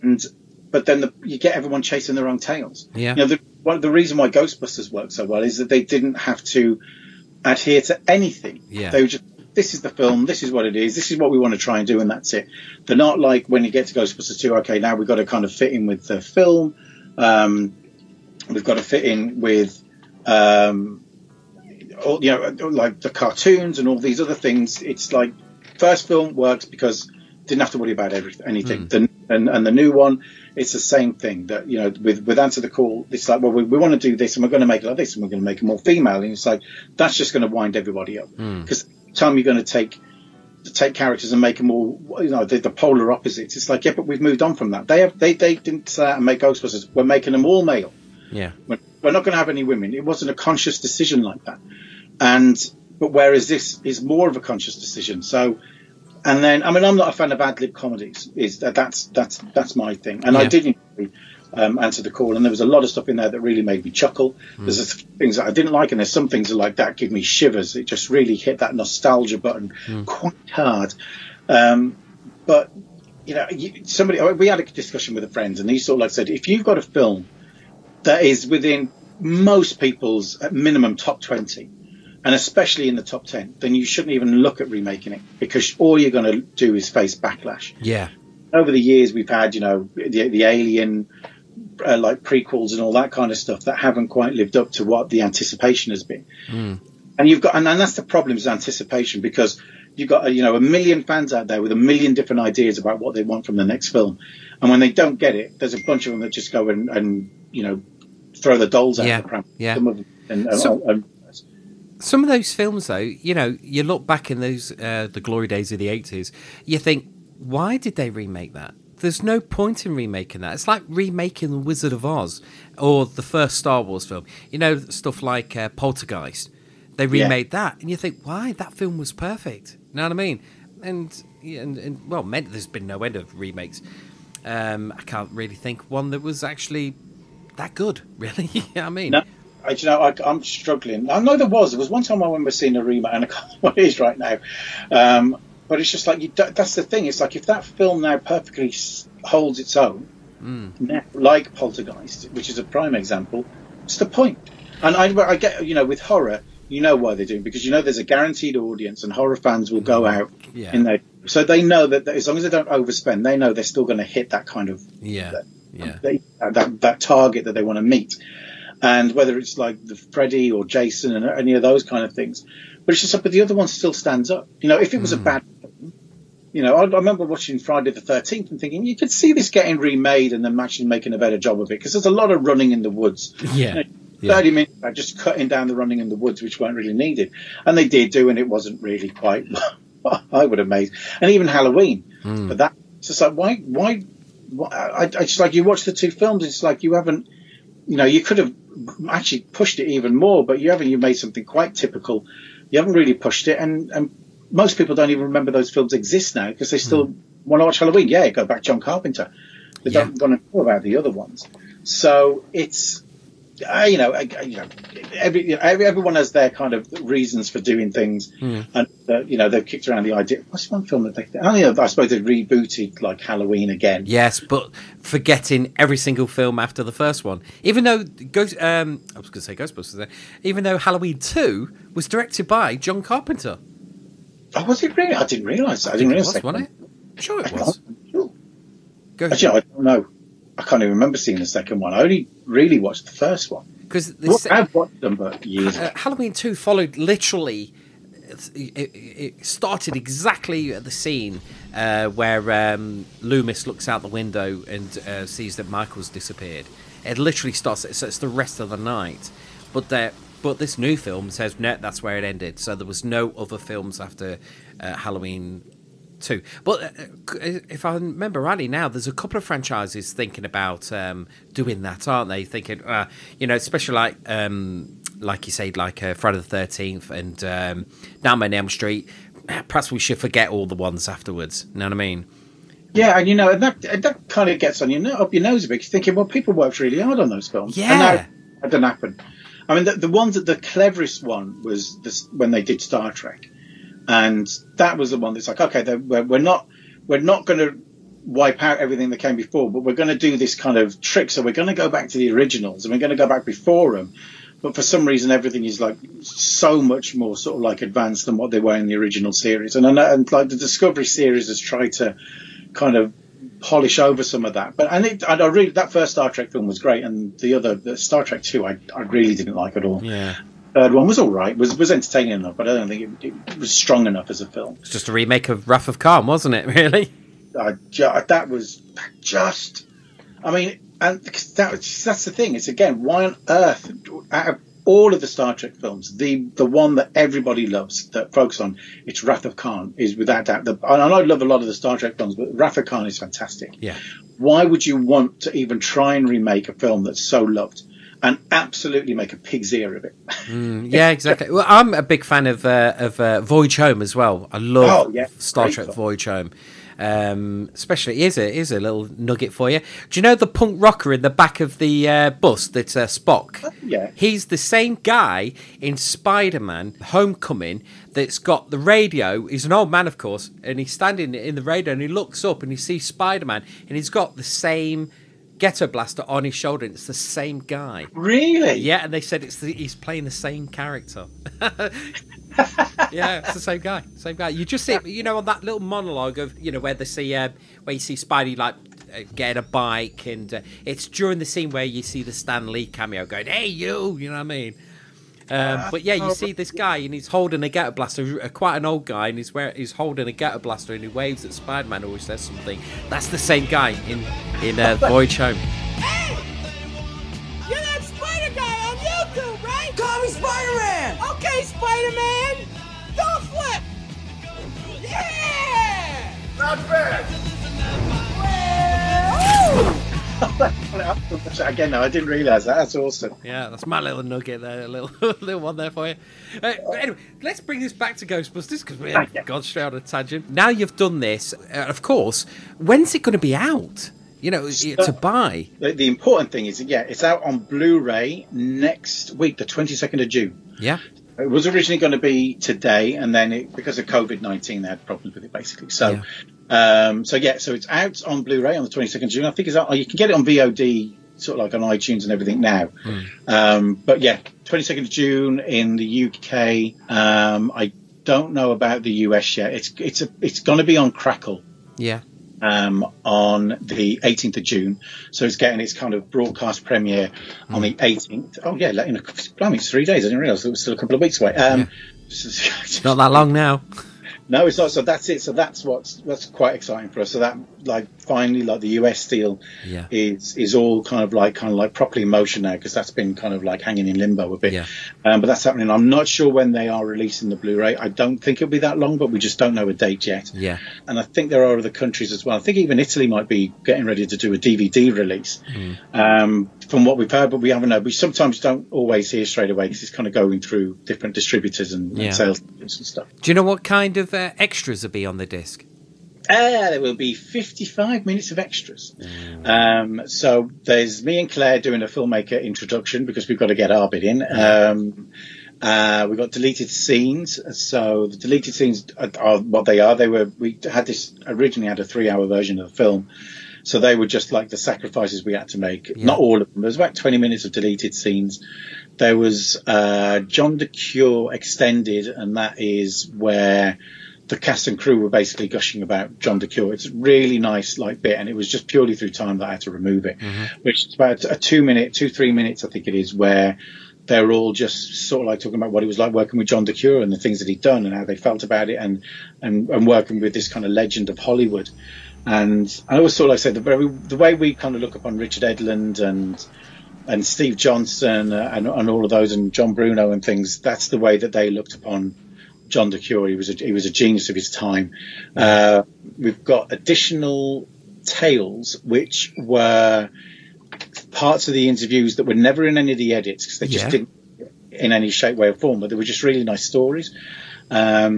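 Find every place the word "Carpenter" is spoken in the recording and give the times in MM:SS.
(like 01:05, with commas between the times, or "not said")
03:28, 03:53.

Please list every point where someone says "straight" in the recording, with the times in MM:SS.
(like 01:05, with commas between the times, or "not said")
07:09, 08:19.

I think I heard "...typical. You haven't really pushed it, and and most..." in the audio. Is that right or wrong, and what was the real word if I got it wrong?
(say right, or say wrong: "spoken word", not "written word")
right.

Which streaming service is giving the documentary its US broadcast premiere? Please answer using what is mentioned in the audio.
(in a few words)
Crackle.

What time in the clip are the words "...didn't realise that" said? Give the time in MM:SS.
07:02.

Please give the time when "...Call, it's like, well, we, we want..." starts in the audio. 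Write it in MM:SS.
00:32.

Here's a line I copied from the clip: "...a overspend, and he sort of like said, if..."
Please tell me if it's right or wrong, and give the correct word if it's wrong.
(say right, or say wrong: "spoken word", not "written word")
wrong: "friend", not "overspend".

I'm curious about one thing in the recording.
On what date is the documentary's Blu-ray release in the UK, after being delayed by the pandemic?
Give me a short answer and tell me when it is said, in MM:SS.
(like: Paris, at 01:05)
22 June, at 07:19.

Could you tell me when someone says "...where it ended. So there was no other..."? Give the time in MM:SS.
04:22.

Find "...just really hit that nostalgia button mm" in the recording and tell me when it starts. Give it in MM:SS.
01:07.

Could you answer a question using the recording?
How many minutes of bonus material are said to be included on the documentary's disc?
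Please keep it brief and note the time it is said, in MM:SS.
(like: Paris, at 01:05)
55, at 08:27.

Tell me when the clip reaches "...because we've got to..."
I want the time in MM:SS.
08:33.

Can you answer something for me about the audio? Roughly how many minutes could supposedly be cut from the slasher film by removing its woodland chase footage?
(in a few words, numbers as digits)
30.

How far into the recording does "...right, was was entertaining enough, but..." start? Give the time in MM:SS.
05:21.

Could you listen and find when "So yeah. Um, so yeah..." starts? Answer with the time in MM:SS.
07:25.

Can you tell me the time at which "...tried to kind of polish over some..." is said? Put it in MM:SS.
05:11.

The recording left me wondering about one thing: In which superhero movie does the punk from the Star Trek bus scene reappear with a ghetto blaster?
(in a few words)
Spider-Man: Homecoming.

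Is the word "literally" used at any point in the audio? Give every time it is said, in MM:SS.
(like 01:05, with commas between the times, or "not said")
04:06, 04:17.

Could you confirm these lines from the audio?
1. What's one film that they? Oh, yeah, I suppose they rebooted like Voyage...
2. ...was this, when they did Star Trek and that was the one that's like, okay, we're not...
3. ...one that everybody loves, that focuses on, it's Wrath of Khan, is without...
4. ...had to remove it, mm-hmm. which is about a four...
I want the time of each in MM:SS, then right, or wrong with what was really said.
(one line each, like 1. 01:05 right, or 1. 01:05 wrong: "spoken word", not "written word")
1. 03:40 wrong: "Halloween", not "Voyage"
2. 04:51 right
3. 05:36 right
4. 08:59 wrong: "two", not "four".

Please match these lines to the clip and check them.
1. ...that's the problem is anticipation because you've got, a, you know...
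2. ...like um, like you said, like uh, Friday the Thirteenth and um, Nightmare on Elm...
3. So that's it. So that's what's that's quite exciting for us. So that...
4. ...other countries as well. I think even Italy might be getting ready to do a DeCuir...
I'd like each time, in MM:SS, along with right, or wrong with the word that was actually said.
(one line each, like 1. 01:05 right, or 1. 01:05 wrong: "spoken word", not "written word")
1. 01:37 right
2. 04:33 right
3. 07:54 right
4. 08:11 wrong: "DVD", not "DeCuir".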